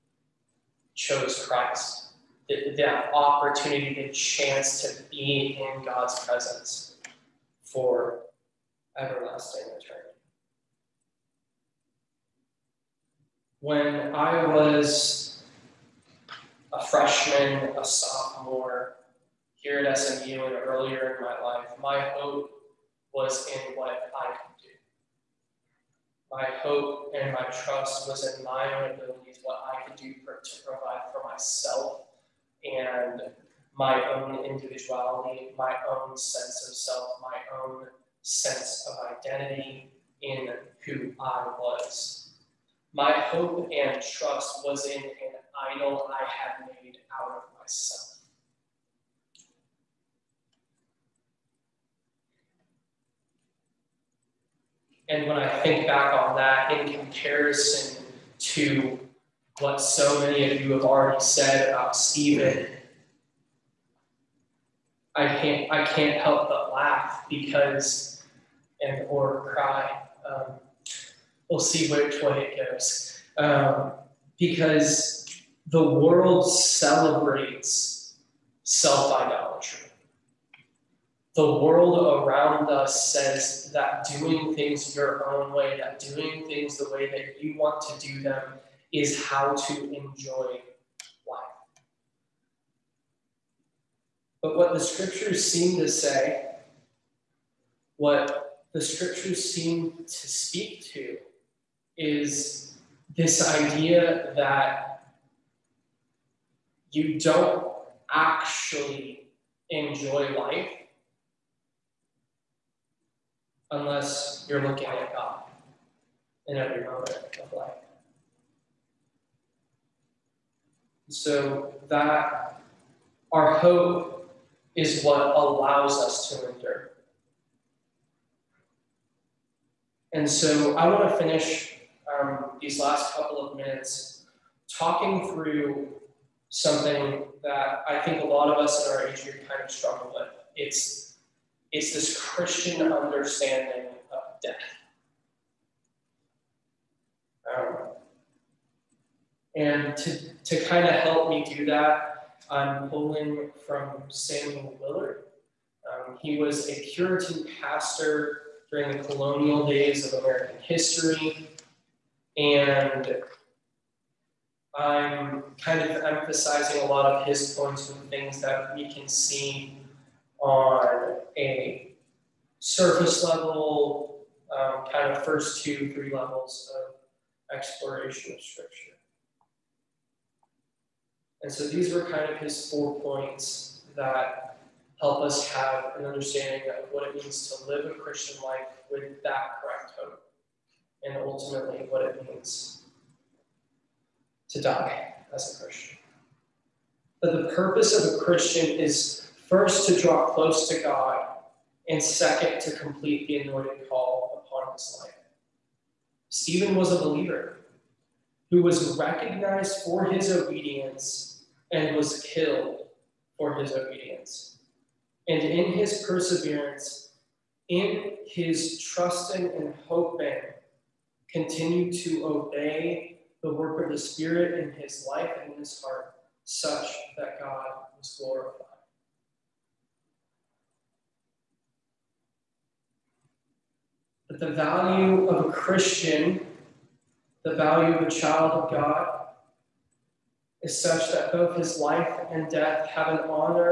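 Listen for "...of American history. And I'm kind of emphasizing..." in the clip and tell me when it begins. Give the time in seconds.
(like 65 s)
160 s.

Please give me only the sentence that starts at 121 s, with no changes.
So that our hope is what allows us to endure.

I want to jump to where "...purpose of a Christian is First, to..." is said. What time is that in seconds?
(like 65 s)
197 s.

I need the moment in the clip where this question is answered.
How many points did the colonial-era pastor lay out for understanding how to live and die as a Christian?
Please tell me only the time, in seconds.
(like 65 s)
182 s.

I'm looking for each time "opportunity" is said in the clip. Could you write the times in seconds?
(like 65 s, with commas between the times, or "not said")
3 s.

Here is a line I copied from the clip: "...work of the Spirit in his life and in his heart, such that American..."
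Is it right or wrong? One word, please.
wrong.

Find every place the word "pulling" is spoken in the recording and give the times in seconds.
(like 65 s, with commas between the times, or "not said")
152 s.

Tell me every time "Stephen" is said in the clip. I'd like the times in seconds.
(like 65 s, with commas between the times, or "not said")
61 s, 206 s.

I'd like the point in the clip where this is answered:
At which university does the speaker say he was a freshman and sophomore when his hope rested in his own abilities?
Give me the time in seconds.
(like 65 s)
19 s.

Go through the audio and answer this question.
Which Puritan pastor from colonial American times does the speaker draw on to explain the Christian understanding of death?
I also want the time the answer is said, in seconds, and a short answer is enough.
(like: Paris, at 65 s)
Samuel Willard, at 154 s.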